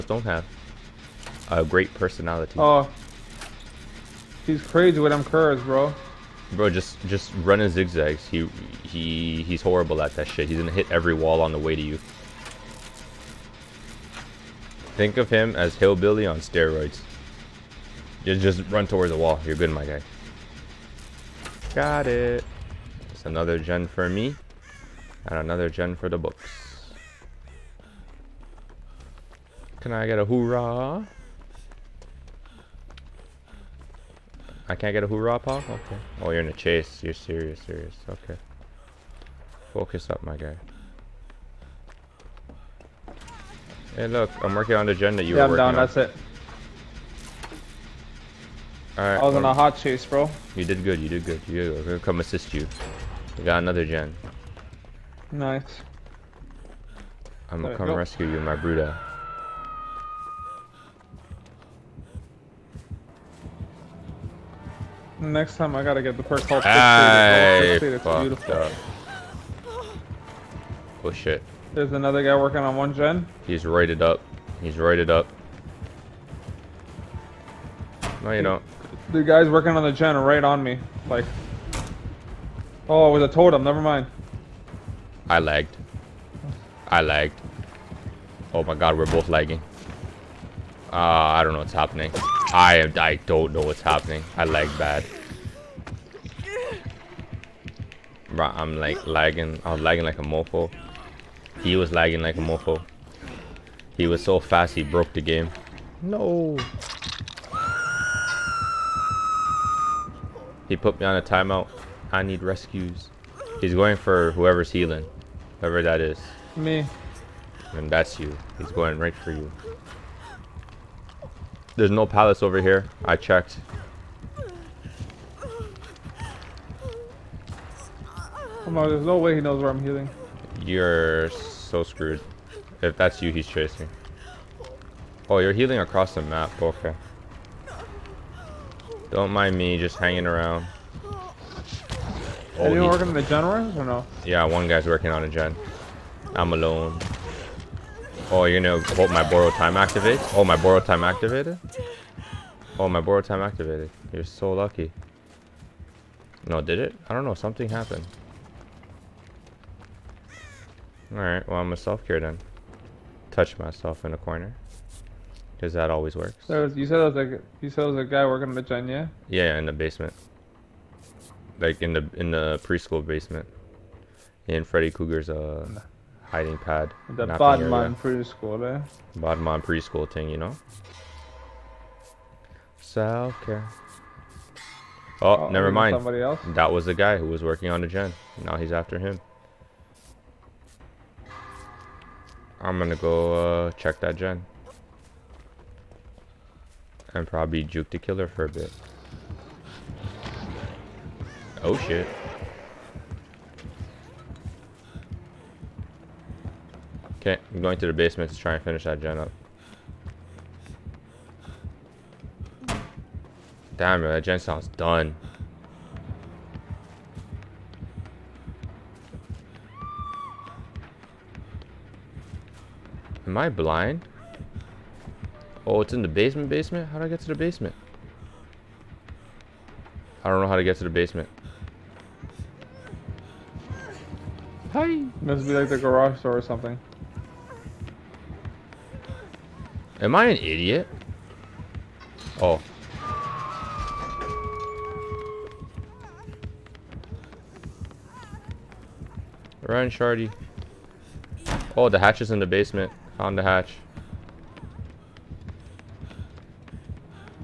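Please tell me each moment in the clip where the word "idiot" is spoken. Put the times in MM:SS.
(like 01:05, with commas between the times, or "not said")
04:00.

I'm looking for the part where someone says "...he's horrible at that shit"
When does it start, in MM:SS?
00:09.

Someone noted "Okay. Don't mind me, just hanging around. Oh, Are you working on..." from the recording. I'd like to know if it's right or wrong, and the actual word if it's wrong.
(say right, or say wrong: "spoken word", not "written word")
right.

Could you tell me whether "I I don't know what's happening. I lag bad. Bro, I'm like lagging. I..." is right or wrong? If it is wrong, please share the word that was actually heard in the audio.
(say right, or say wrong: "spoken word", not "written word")
right.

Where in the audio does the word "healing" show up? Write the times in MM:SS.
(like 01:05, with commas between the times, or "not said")
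01:54, 02:09, 02:15.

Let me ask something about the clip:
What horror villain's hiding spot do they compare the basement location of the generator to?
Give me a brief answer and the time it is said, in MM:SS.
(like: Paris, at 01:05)
Freddy Krueger, at 02:54.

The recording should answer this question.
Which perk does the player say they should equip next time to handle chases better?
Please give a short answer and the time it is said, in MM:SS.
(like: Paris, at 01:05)
Fixated, at 01:06.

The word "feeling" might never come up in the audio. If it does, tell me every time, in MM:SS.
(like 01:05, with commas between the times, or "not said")
not said.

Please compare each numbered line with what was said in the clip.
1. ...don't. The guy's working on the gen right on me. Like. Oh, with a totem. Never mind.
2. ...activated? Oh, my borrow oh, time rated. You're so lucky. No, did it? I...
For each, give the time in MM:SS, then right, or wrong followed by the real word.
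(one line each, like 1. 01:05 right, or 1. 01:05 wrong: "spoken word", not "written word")
1. 01:18 right
2. 02:31 wrong: "activated", not "rated".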